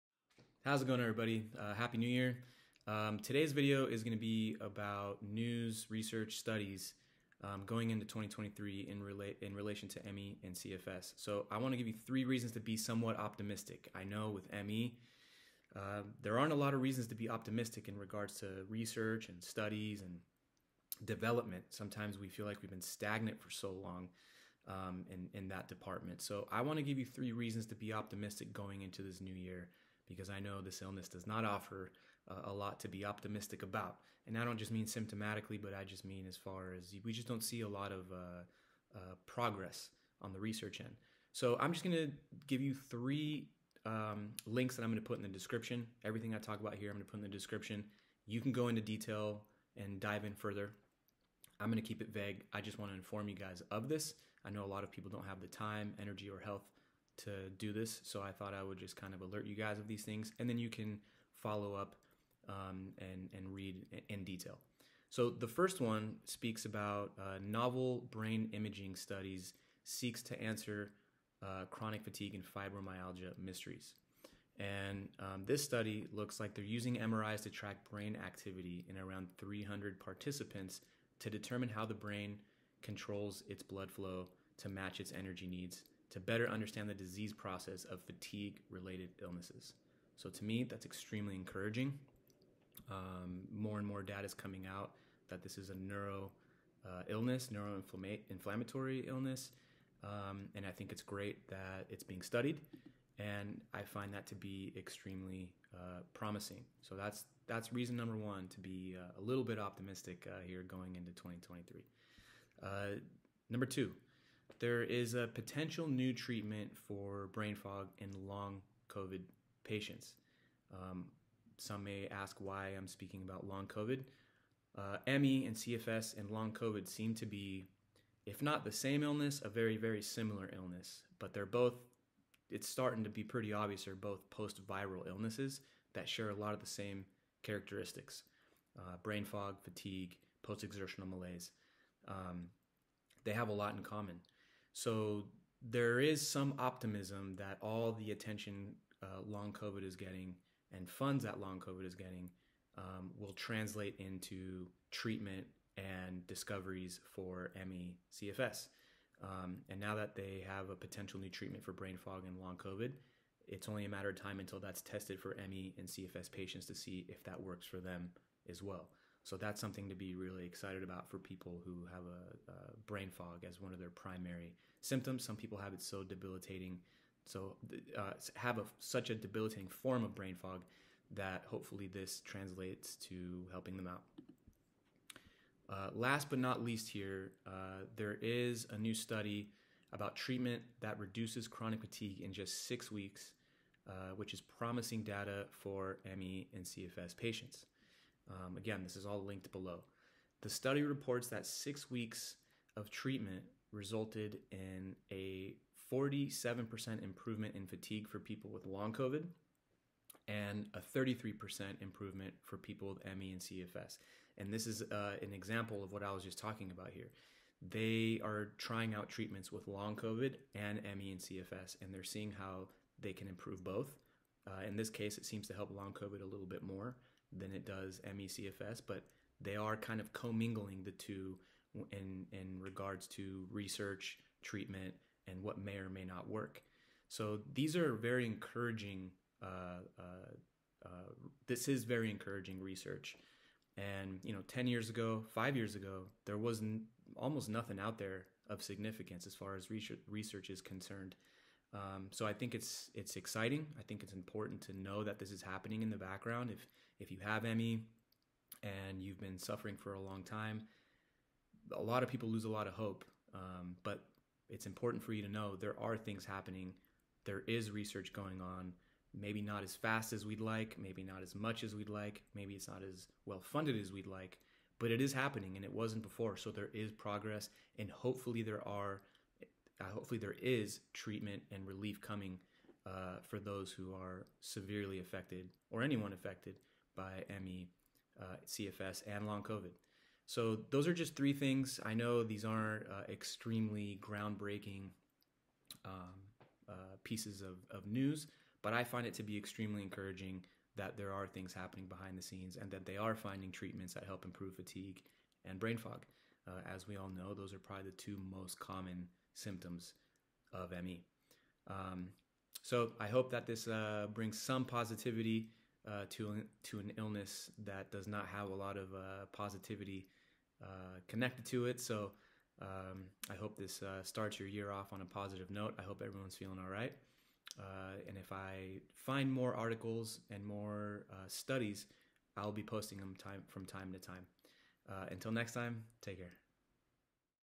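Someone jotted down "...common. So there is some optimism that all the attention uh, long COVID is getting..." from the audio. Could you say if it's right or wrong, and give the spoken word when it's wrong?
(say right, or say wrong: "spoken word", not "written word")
right.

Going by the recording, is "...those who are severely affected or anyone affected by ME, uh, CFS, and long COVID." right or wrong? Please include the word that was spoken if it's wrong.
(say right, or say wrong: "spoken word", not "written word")
right.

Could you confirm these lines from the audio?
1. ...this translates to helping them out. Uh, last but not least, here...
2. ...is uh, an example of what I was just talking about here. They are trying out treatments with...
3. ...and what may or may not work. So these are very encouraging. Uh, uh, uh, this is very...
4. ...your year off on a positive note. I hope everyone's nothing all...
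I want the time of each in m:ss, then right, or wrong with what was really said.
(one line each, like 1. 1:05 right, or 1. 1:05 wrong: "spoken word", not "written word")
1. 3:01 right
2. 3:34 right
3. 3:55 right
4. 5:24 wrong: "feeling", not "nothing".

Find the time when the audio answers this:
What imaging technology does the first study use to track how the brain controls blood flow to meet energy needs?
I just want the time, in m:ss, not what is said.
1:16.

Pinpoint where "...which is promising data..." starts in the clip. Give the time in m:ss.
3:14.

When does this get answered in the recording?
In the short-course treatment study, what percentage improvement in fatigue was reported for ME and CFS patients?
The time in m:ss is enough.
3:30.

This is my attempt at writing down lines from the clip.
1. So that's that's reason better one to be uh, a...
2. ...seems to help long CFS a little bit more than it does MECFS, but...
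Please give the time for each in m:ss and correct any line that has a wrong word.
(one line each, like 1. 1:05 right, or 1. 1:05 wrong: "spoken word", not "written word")
1. 1:46 wrong: "number", not "better"
2. 3:45 wrong: "COVID", not "CFS".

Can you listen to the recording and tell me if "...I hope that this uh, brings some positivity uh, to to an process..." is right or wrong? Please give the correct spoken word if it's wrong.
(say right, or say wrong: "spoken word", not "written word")
wrong: "illness", not "process".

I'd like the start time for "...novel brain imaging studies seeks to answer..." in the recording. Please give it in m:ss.
1:07.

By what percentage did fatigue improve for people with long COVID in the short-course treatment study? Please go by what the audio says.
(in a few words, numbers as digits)
47%.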